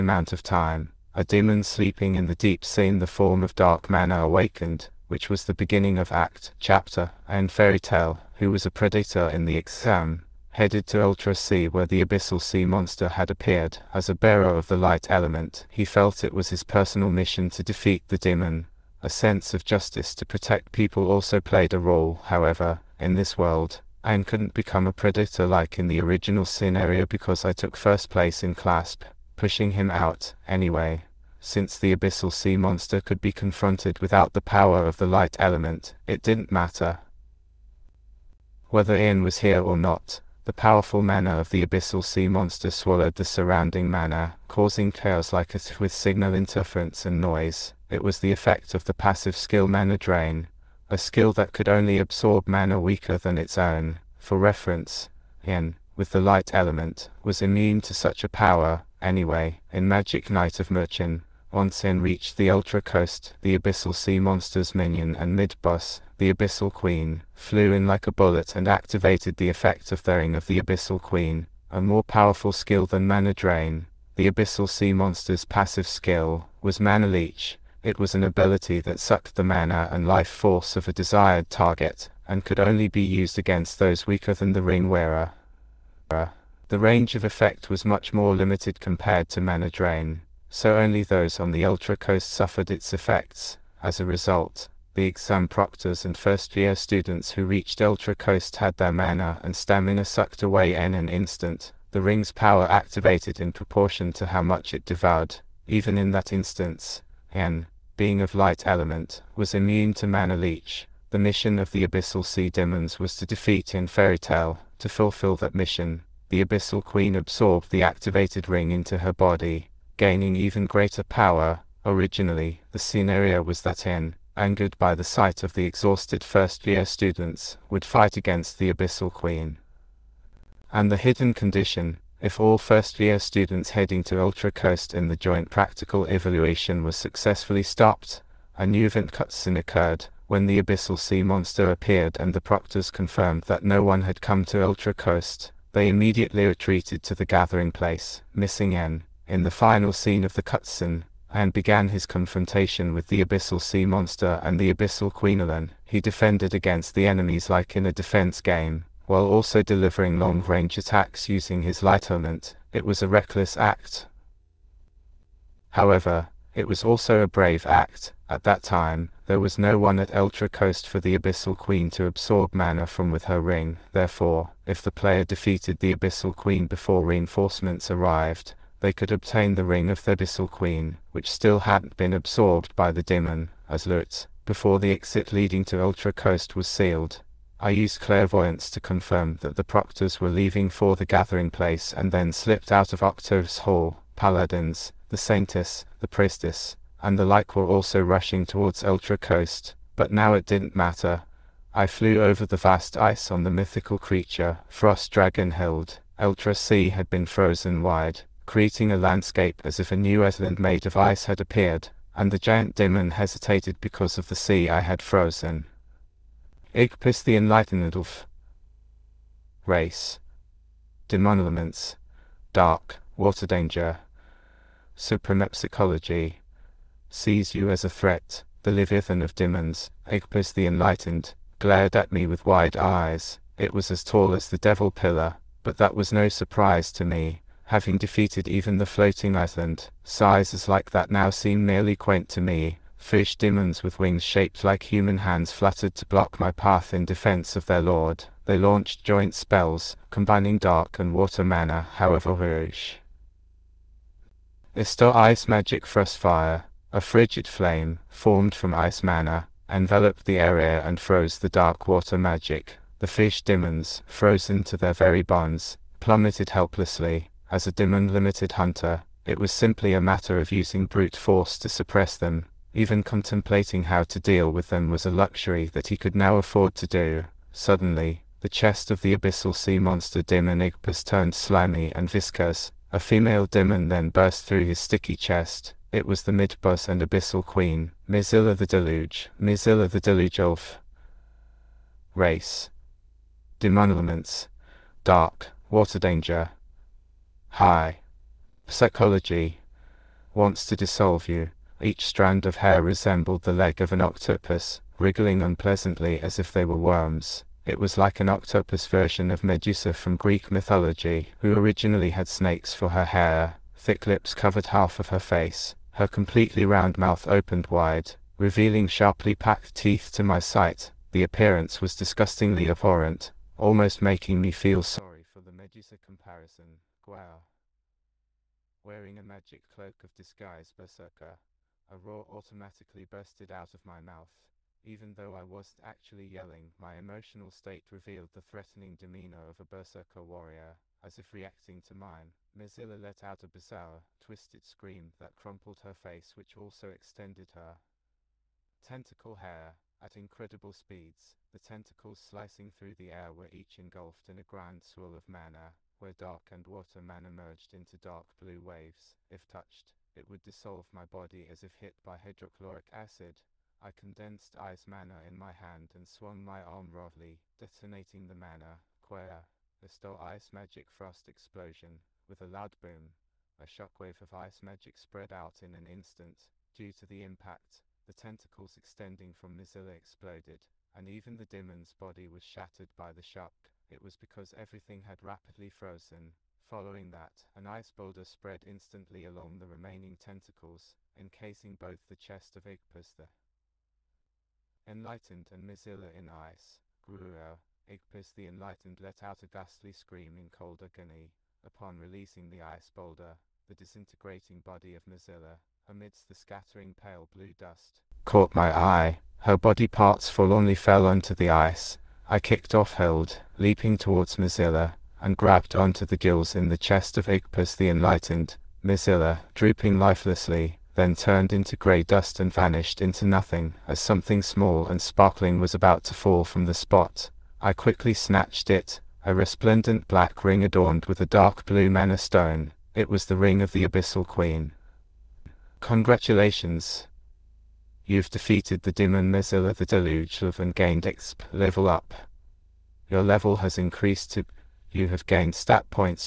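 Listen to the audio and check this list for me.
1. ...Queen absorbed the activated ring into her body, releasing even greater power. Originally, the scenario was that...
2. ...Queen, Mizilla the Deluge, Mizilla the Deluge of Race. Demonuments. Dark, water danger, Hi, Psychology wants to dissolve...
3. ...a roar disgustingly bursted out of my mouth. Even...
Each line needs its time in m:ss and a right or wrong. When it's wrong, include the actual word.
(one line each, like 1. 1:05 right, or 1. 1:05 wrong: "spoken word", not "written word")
1. 1:56 wrong: "gaining", not "releasing"
2. 4:47 right
3. 5:31 wrong: "automatically", not "disgustingly".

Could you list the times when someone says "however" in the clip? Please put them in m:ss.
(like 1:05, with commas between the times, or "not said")
0:22, 2:45, 4:11.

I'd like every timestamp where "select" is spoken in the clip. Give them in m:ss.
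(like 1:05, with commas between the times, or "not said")
not said.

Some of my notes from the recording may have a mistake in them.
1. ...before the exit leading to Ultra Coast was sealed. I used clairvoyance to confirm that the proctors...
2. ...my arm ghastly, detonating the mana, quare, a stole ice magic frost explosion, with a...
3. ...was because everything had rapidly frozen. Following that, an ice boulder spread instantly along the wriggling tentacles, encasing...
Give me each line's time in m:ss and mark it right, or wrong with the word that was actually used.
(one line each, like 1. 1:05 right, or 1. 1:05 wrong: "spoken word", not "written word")
1. 3:04 right
2. 6:06 wrong: "roughly", not "ghastly"
3. 6:24 wrong: "remaining", not "wriggling".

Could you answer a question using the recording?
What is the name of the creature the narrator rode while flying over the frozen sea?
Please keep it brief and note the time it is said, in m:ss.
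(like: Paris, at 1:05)
Frost Dragon Hild, at 3:24.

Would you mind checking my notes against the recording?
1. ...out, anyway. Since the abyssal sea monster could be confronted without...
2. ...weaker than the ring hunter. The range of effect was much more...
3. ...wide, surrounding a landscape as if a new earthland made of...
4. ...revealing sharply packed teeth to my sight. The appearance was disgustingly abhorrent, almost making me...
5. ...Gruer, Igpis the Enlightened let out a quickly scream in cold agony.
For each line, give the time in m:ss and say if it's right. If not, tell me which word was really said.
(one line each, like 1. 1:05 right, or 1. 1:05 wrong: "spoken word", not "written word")
1. 0:29 right
2. 1:24 wrong: "wearer", not "hunter"
3. 3:27 wrong: "creating", not "surrounding"
4. 5:18 right
5. 6:37 wrong: "ghastly", not "quickly".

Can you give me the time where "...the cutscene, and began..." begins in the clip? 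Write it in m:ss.
2:30.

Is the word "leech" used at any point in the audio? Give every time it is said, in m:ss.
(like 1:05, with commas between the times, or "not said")
1:17, 1:50.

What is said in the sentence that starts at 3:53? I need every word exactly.
It was as tall as the devil pillar, but that was no surprise to me, having defeated even the floating island.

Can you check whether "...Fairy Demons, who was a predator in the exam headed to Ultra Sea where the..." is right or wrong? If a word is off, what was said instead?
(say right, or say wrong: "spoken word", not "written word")
wrong: "Tale", not "Demons".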